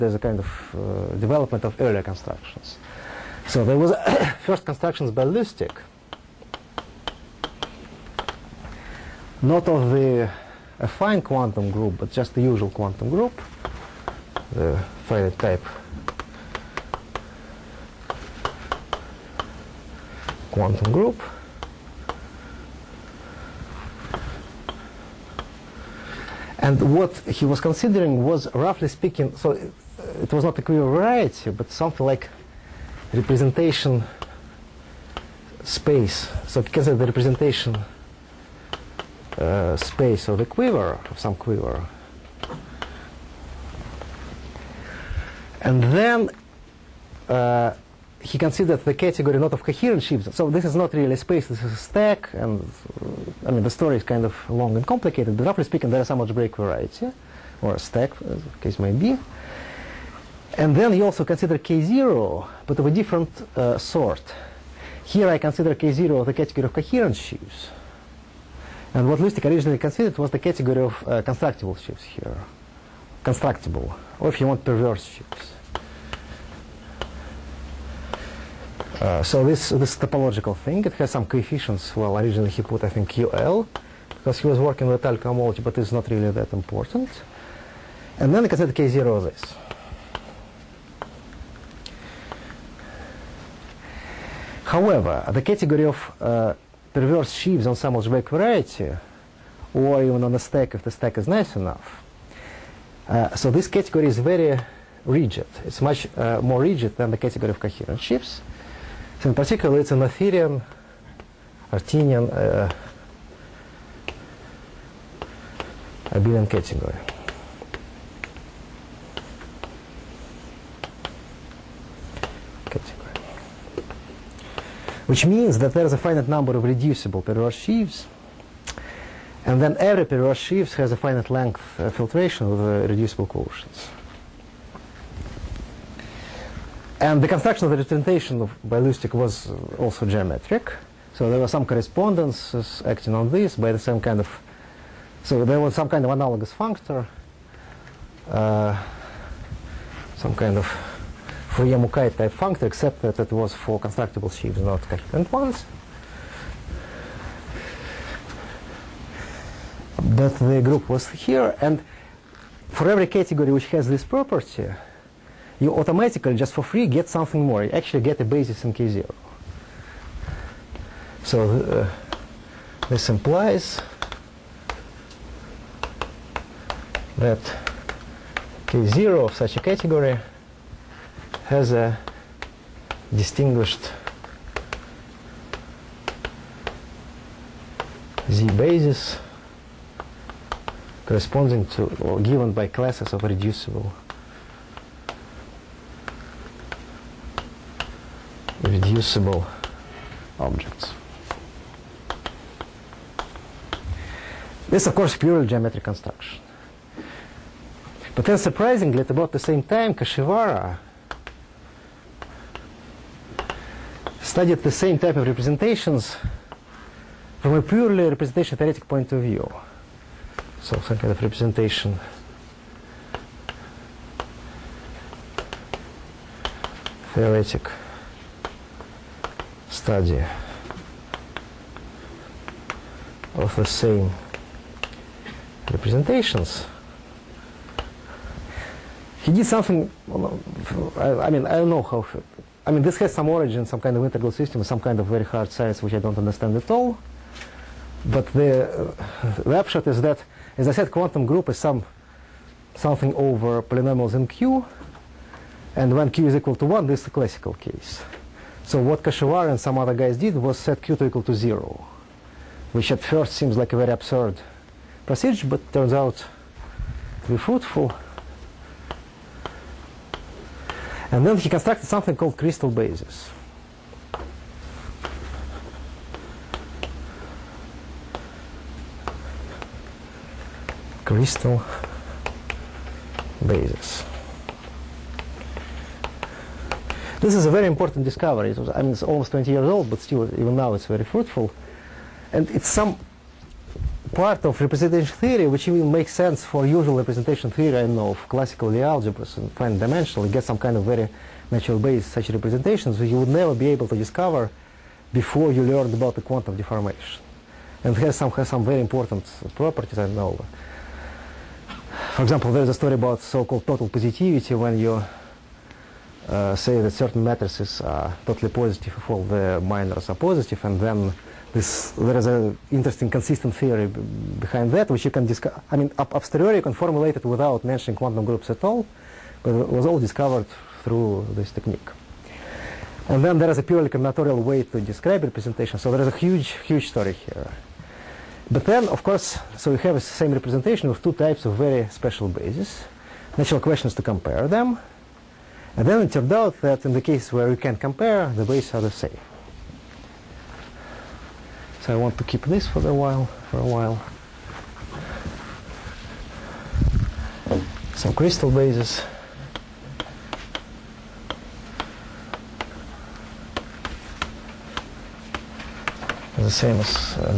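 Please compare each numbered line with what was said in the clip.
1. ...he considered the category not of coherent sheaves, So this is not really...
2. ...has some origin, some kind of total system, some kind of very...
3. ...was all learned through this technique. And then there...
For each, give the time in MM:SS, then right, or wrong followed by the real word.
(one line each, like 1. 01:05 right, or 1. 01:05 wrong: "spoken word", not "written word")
1. 00:48 right
2. 04:02 wrong: "integral", not "total"
3. 05:29 wrong: "discovered", not "learned".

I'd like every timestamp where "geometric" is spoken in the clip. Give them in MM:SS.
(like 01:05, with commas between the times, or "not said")
02:20, 03:25.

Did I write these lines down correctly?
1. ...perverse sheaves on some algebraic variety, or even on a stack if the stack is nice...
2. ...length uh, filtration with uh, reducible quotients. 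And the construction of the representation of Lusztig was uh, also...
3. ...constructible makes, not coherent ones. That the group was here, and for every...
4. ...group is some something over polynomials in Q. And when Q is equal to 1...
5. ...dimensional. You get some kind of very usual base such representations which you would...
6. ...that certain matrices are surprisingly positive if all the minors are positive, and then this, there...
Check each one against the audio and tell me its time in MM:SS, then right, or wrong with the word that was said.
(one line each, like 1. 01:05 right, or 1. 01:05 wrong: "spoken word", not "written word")
1. 01:36 right
2. 02:11 right
3. 02:33 wrong: "sheaves", not "makes"
4. 04:11 right
5. 04:59 wrong: "natural", not "usual"
6. 05:16 wrong: "totally", not "surprisingly".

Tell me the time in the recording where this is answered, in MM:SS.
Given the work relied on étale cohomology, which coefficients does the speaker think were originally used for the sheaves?
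01:23.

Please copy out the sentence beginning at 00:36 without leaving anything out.
So consider the representation uh, space of a quiver, of some quiver.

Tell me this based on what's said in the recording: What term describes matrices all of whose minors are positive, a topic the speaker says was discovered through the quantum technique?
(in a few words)
total positivity.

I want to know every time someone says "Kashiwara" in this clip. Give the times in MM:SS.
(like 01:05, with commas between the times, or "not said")
03:29, 04:19.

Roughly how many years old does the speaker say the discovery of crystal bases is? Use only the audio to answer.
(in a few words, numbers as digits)
20.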